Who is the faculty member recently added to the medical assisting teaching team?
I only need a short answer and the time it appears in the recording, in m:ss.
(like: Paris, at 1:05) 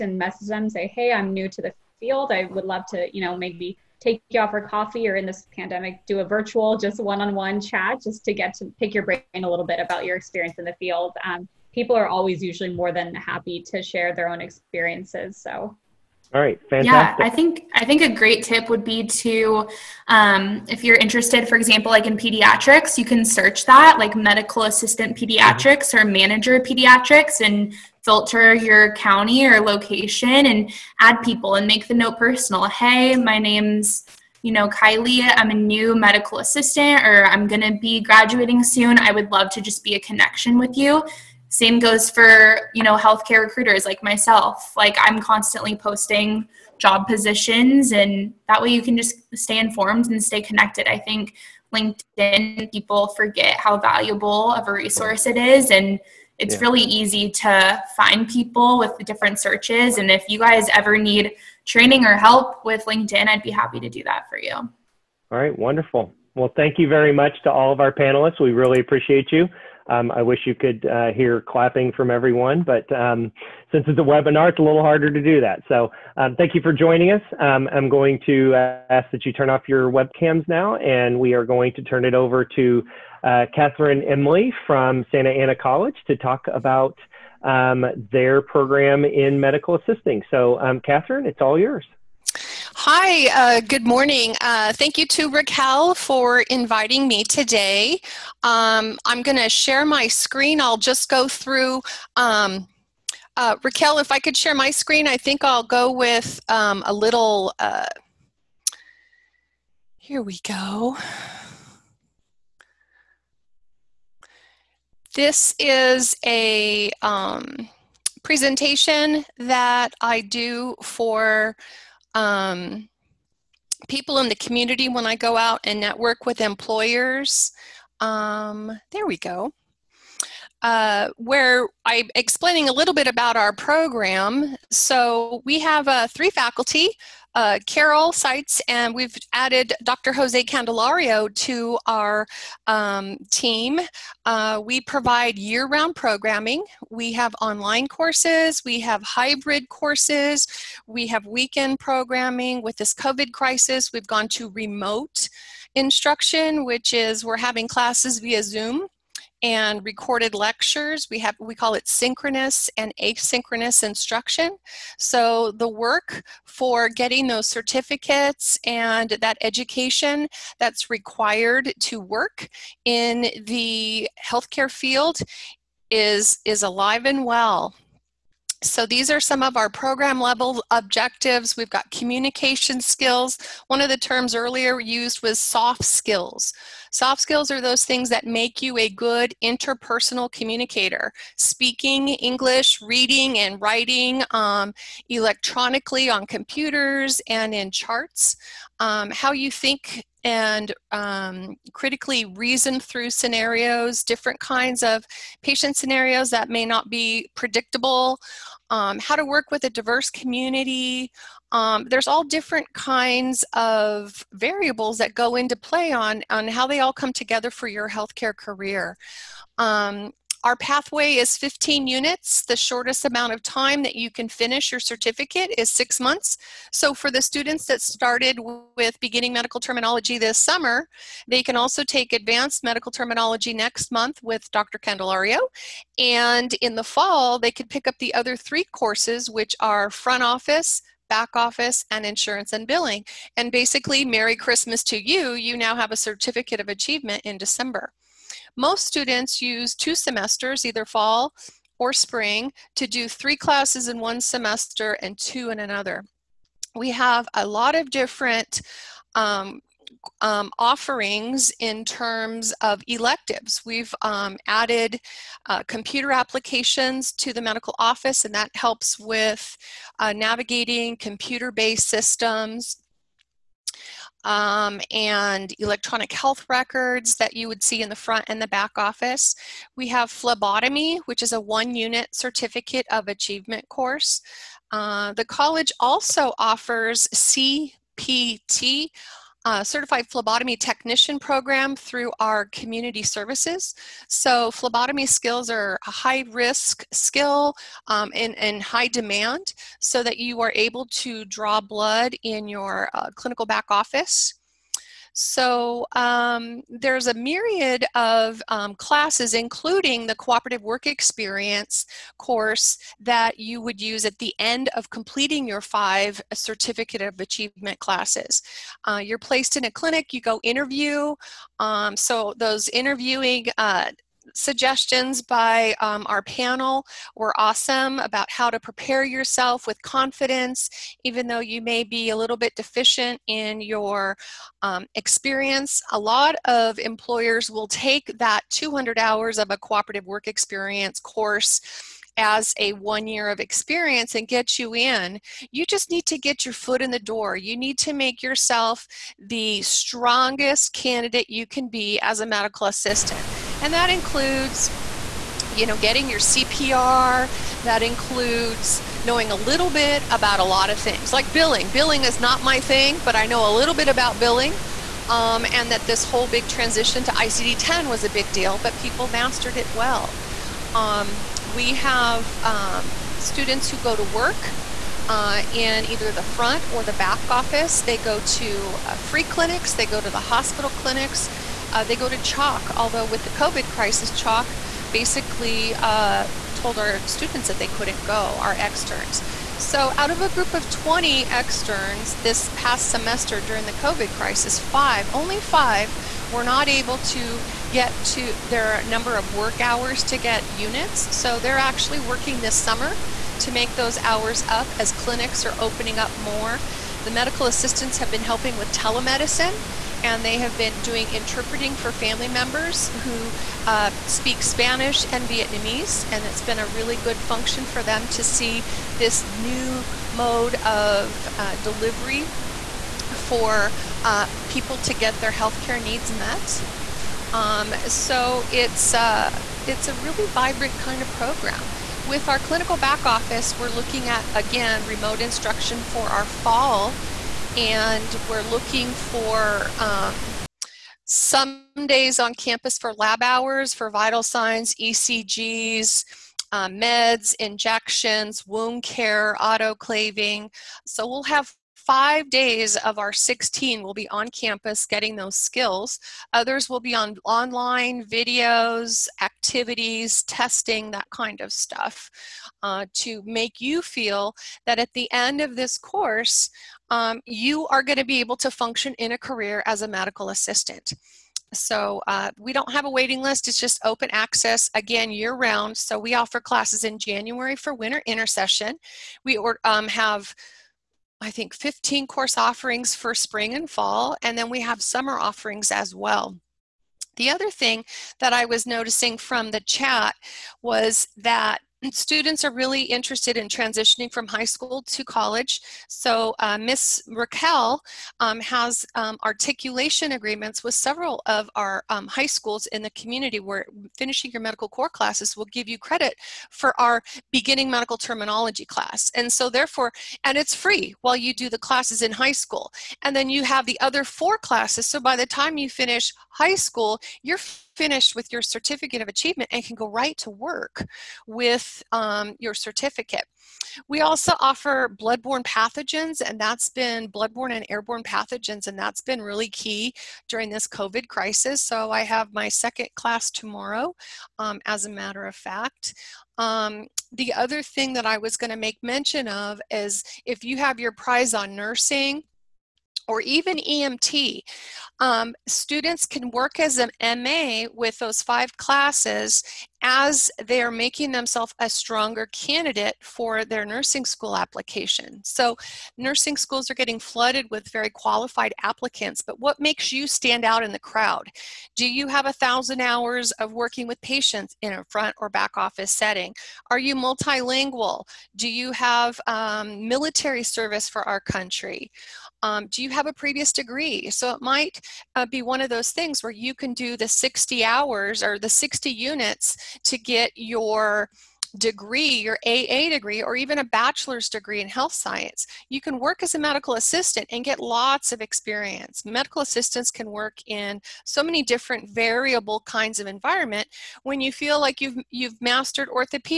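Dr. Jose Candelario, at 2:19.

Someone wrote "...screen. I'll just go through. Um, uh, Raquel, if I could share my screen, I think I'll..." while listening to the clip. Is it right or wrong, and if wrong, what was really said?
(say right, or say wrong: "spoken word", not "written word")
right.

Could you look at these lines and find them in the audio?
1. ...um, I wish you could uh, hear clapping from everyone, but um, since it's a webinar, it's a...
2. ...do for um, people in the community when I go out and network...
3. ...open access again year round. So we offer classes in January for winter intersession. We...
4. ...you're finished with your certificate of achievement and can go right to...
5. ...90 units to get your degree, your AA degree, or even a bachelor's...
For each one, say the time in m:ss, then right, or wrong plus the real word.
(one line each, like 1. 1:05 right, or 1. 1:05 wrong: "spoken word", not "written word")
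1. 1:09 right
2. 2:00 right
3. 7:53 right
4. 8:37 right
5. 9:38 wrong: "60", not "90".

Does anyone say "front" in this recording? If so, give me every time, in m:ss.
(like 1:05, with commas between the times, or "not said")
3:59, 4:37, 6:16, 9:24.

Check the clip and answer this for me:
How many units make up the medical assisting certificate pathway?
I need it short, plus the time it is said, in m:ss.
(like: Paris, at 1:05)
15, at 3:41.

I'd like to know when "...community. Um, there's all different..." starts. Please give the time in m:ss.
3:30.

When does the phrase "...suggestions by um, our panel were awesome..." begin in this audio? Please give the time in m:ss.
5:24.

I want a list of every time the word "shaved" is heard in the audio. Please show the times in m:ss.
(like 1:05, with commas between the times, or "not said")
not said.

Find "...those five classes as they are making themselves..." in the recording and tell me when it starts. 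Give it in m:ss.
9:07.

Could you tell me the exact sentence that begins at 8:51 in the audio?
So I have my second class tomorrow, um, as a matter of fact.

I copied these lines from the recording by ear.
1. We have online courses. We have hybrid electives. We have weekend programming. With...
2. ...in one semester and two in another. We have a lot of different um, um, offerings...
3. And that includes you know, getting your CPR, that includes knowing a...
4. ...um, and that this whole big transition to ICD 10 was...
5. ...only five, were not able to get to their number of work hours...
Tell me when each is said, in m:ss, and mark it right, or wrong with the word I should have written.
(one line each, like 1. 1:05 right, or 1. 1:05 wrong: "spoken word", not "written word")
1. 2:26 wrong: "courses", not "electives"
2. 4:13 right
3. 5:53 right
4. 6:05 right
5. 6:35 right.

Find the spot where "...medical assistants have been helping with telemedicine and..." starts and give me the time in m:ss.
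6:47.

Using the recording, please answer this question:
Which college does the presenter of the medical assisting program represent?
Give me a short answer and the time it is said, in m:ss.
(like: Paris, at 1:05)
Santa Ana College, at 1:25.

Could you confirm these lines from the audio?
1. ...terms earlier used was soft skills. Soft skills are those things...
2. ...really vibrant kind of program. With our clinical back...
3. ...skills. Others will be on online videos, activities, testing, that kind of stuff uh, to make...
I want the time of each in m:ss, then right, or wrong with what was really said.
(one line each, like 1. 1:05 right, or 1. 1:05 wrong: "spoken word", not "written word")
1. 3:03 right
2. 7:09 right
3. 7:35 right.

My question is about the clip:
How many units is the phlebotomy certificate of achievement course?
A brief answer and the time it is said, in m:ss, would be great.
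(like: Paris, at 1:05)
1, at 4:41.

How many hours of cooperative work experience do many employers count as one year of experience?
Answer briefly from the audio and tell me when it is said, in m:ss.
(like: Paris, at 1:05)
200, at 5:38.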